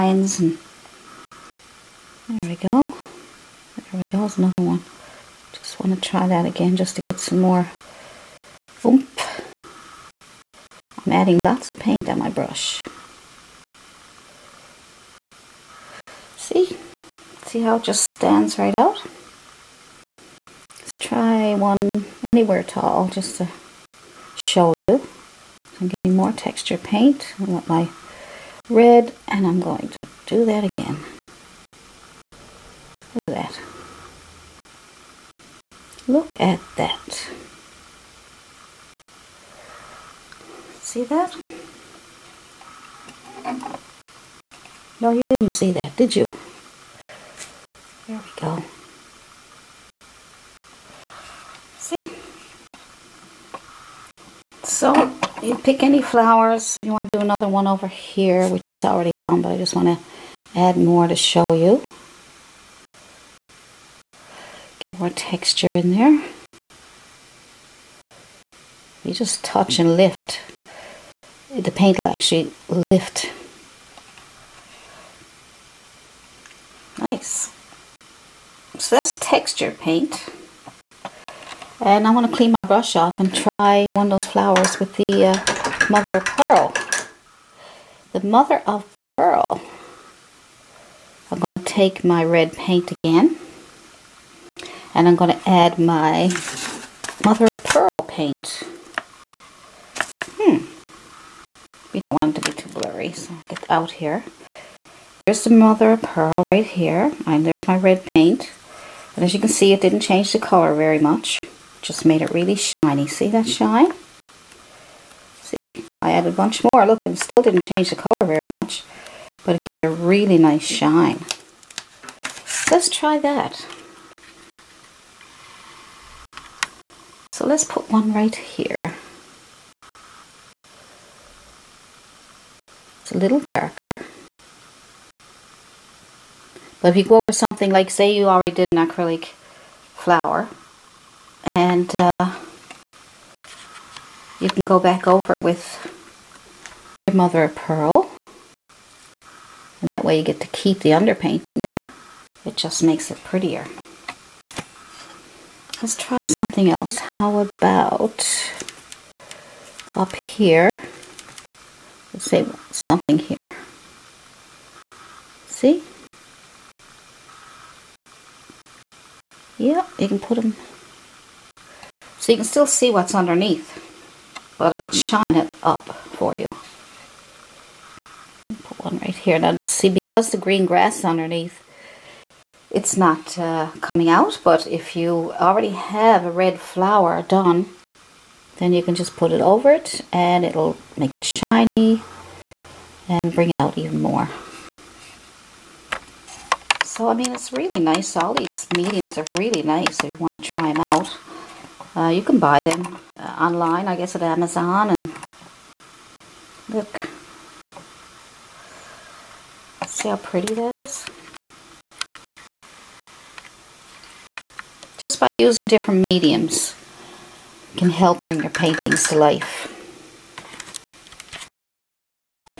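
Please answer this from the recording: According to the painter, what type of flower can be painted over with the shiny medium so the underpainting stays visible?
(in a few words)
an acrylic flower.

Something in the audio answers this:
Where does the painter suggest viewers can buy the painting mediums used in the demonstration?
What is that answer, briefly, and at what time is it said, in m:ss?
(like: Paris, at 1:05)
Amazon, at 3:24.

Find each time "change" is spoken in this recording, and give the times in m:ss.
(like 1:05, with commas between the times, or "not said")
1:50, 1:57.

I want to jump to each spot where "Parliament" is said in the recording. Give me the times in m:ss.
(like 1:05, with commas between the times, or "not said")
not said.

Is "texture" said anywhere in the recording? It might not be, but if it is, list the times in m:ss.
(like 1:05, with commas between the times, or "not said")
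0:26, 1:05, 1:19.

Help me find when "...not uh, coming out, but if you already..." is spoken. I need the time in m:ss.
3:02.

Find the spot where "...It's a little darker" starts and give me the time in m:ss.
2:13.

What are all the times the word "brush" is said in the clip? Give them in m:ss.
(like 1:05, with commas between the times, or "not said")
0:12, 1:22.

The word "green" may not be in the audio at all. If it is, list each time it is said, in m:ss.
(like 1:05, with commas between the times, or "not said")
3:00.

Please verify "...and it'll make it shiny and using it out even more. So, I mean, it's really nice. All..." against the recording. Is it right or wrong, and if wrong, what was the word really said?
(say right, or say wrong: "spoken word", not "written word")
wrong: "bring", not "using".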